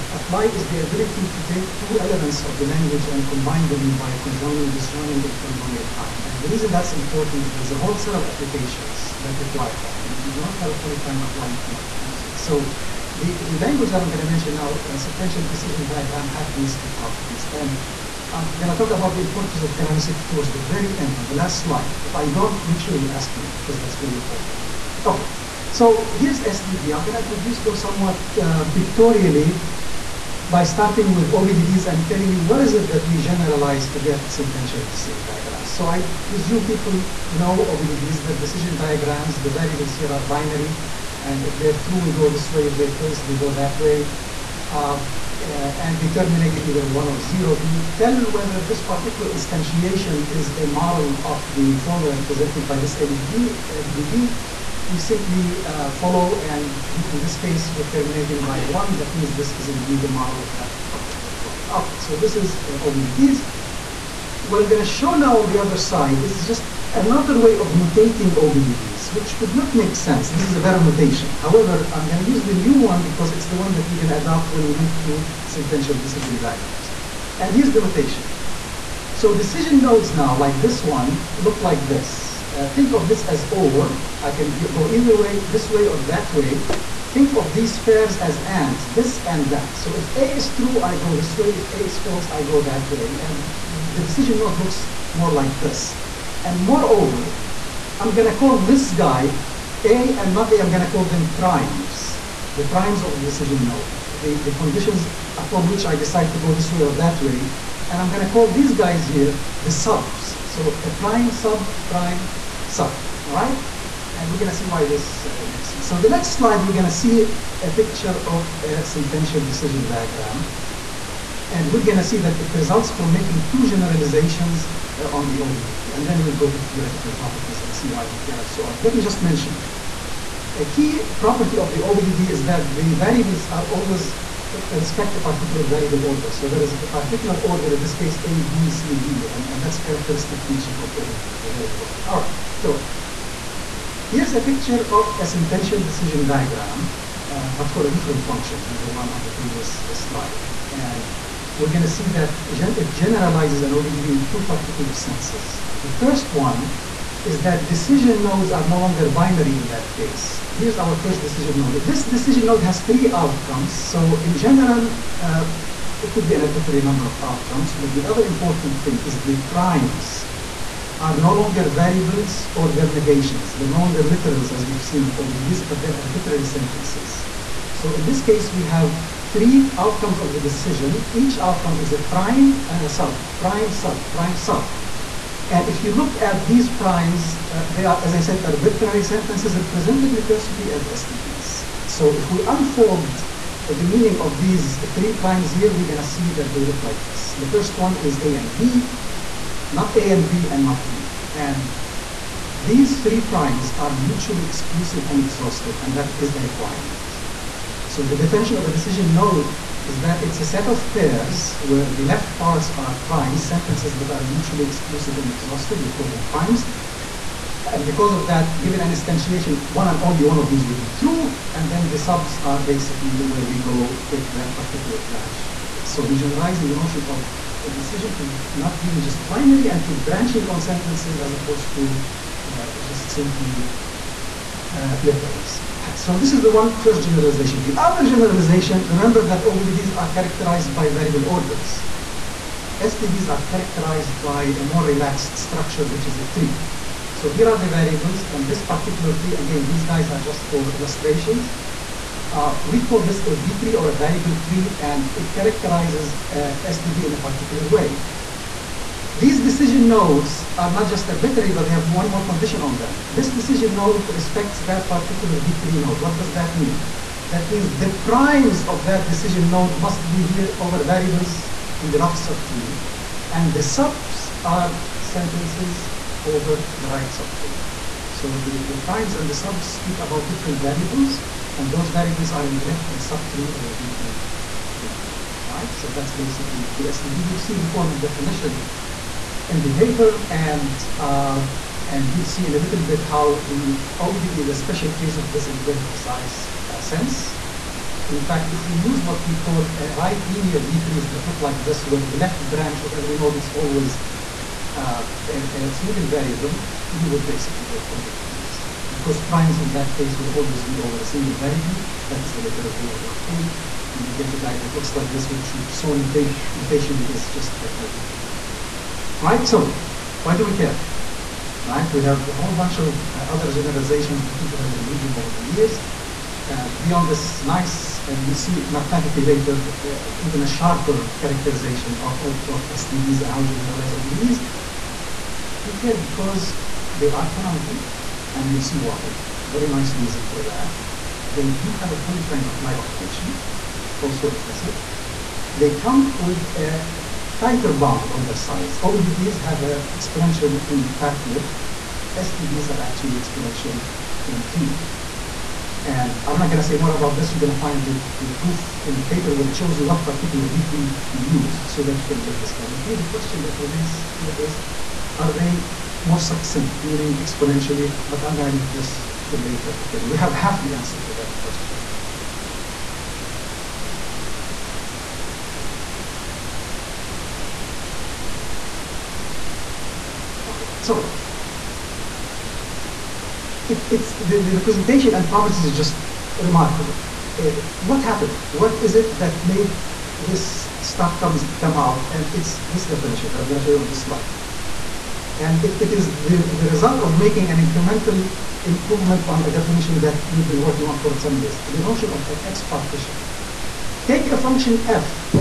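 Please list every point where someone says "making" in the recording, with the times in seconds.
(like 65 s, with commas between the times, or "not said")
123 s, 397 s.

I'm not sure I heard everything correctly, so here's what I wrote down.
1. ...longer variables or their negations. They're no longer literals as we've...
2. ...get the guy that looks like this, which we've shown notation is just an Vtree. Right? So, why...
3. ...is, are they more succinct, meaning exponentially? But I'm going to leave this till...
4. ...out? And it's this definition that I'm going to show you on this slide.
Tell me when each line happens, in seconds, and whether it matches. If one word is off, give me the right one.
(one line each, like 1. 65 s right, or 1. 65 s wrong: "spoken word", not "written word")
1. 171 s right
2. 314 s wrong: "OBDD", not "Vtree"
3. 364 s right
4. 391 s right.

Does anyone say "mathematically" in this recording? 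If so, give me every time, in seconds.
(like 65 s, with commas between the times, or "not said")
328 s.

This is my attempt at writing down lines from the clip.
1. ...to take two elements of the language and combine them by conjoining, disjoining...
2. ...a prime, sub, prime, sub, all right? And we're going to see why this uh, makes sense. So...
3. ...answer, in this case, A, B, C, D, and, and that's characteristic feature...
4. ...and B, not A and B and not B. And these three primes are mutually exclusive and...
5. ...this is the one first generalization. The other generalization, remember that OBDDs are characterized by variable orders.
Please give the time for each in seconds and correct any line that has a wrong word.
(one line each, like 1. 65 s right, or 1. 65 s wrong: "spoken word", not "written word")
1. 1 s right
2. 110 s right
3. 137 s wrong: "order", not "answer"
4. 198 s right
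5. 236 s right.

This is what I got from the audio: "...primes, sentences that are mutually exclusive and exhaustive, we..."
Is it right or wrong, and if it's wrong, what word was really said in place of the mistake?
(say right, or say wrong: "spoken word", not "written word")
right.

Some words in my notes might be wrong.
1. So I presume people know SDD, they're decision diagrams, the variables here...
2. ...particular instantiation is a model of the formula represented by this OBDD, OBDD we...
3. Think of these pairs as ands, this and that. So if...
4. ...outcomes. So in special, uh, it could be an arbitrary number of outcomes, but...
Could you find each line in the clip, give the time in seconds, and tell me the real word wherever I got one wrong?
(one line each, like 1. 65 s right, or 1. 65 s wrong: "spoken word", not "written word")
1. 35 s wrong: "OBDDs", not "SDD"
2. 48 s right
3. 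87 s right
4. 163 s wrong: "general", not "special".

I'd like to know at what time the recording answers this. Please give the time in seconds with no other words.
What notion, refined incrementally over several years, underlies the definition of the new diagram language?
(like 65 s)
401 s.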